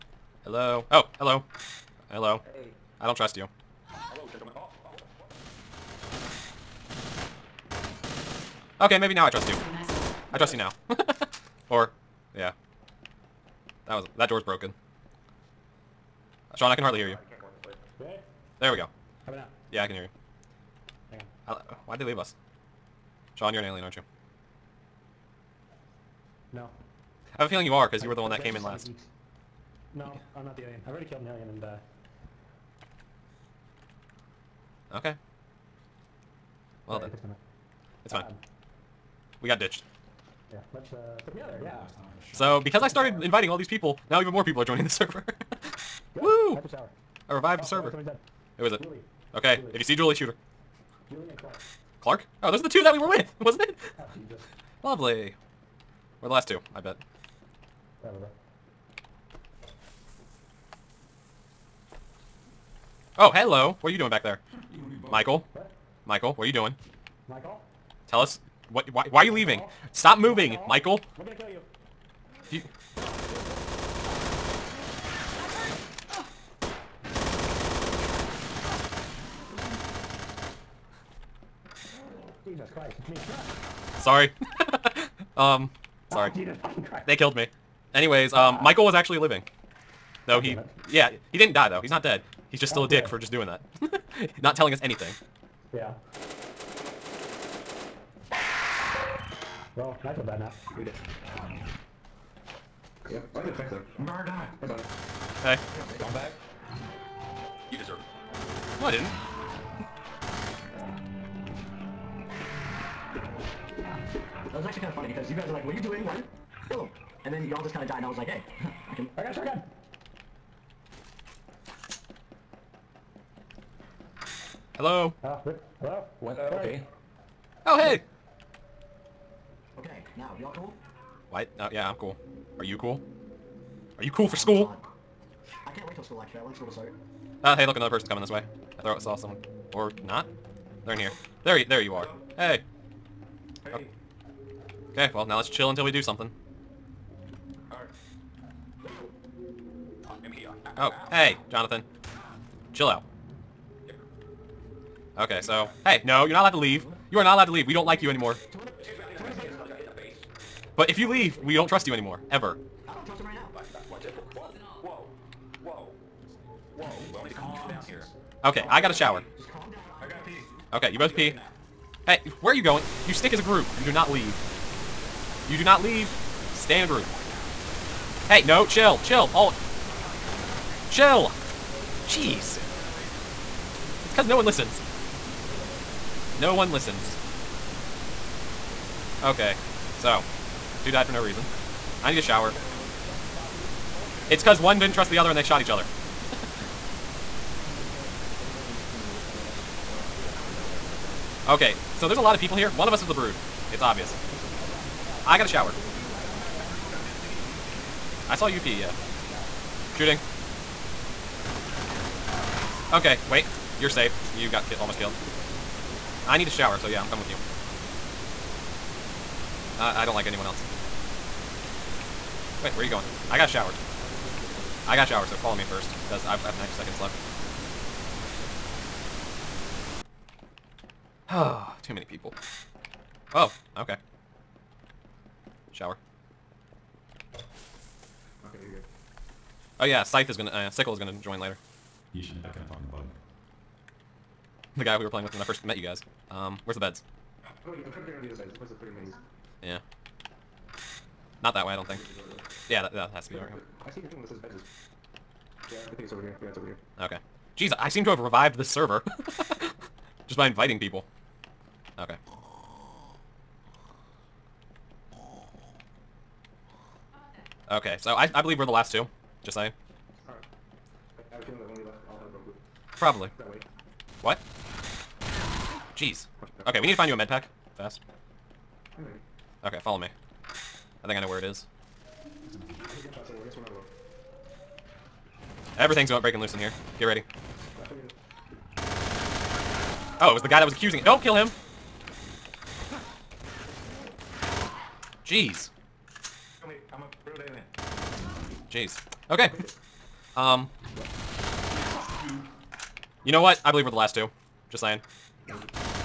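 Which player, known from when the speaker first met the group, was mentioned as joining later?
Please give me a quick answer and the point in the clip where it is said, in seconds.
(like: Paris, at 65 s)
Sickle, at 240 s.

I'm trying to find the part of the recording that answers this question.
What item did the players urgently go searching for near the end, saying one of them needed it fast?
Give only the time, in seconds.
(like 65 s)
277 s.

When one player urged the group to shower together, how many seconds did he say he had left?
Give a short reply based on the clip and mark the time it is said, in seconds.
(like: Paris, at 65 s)
90, at 226 s.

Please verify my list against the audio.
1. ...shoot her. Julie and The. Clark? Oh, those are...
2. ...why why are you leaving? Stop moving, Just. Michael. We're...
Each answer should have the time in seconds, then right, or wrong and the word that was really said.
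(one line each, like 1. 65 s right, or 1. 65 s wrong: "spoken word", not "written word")
1. 50 s wrong: "Clark", not "The"
2. 68 s wrong: "Michael", not "Just".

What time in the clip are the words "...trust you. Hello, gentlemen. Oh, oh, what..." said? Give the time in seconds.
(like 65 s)
3 s.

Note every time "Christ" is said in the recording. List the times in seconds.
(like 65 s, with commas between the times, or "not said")
82 s, 86 s.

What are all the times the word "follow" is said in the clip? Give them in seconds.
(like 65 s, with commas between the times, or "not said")
225 s, 279 s.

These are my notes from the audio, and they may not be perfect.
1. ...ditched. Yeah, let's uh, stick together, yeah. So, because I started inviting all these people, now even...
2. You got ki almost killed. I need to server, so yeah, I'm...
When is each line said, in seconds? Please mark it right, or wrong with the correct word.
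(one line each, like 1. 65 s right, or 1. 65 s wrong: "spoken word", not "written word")
1. 39 s right
2. 214 s wrong: "shower", not "server".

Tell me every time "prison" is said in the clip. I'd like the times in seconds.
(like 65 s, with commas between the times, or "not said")
not said.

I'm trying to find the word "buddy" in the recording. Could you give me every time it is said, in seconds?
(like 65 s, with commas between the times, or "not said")
104 s.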